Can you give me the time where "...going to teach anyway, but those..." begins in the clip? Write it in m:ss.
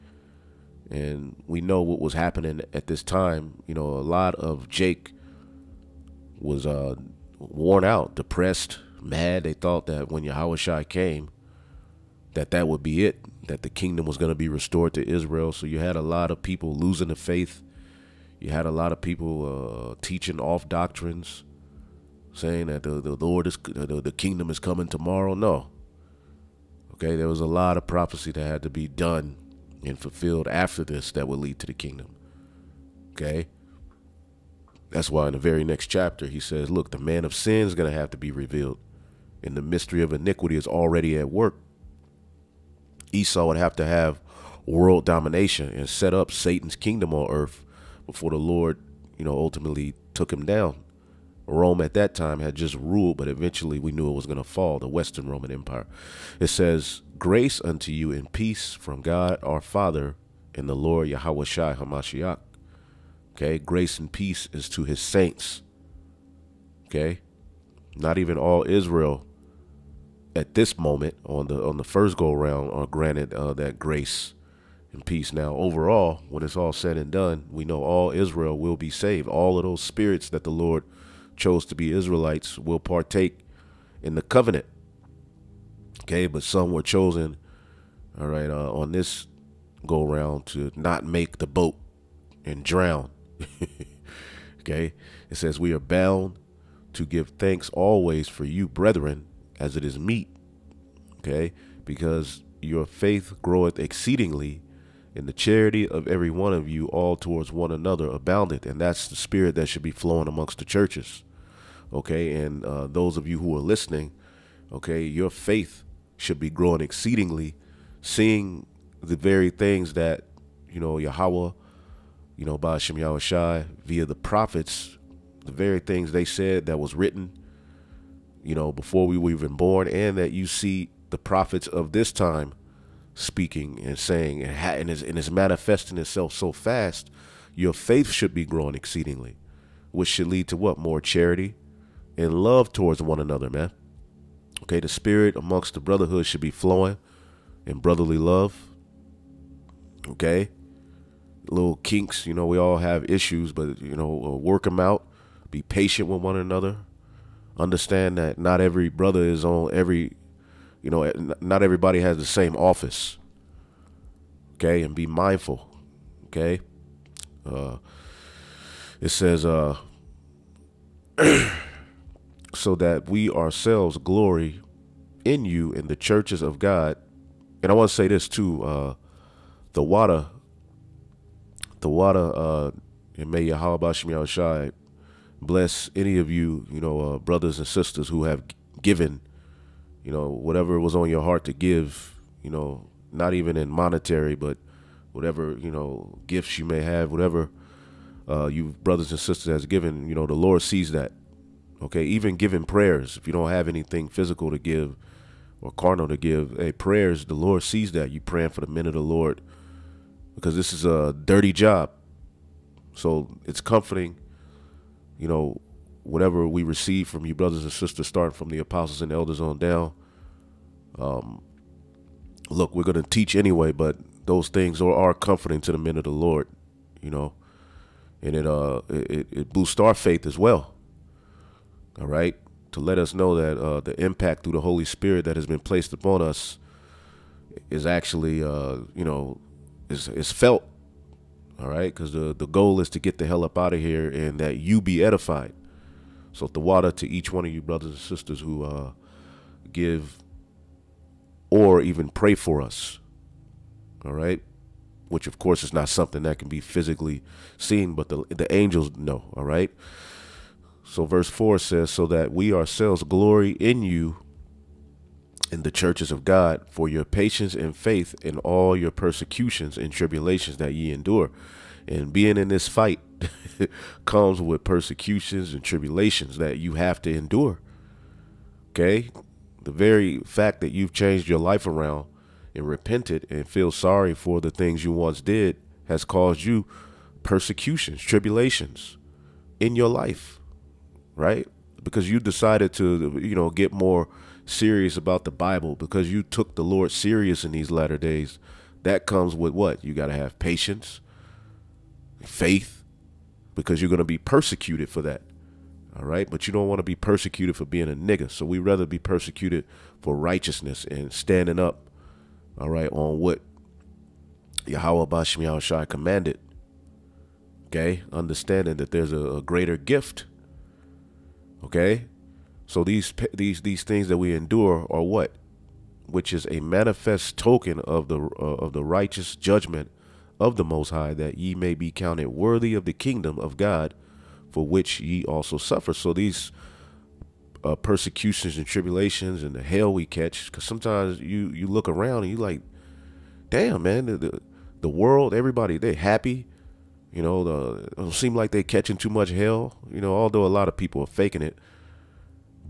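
3:42.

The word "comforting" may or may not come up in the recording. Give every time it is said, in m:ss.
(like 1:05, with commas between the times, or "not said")
3:33, 3:45.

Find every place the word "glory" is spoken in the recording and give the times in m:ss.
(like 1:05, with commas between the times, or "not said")
2:53, 4:23.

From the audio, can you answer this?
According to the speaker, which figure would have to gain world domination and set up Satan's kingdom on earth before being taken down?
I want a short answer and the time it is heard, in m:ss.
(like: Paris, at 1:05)
Esau, at 0:43.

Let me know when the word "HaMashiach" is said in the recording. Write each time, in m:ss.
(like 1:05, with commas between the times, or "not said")
1:01.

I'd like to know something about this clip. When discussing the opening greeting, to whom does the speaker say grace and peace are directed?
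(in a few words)
his saints.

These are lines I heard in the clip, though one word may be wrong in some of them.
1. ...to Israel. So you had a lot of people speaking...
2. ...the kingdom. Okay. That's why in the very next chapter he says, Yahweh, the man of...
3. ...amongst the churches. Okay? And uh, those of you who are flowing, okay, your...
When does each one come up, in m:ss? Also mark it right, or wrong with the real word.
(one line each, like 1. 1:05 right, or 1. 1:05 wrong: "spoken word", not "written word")
1. 0:14 wrong: "losing", not "speaking"
2. 0:31 wrong: "Look", not "Yahweh"
3. 1:50 wrong: "listening", not "flowing".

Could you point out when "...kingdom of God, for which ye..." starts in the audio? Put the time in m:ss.
5:32.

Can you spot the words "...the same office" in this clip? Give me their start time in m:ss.
2:42.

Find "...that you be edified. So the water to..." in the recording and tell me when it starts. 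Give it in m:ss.
4:04.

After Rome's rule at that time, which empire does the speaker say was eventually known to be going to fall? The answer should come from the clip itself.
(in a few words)
Western Roman Empire.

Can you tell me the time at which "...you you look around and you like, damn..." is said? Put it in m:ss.
5:41.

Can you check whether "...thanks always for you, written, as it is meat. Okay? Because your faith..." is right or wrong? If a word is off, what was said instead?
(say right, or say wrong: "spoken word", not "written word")
wrong: "brethren", not "written".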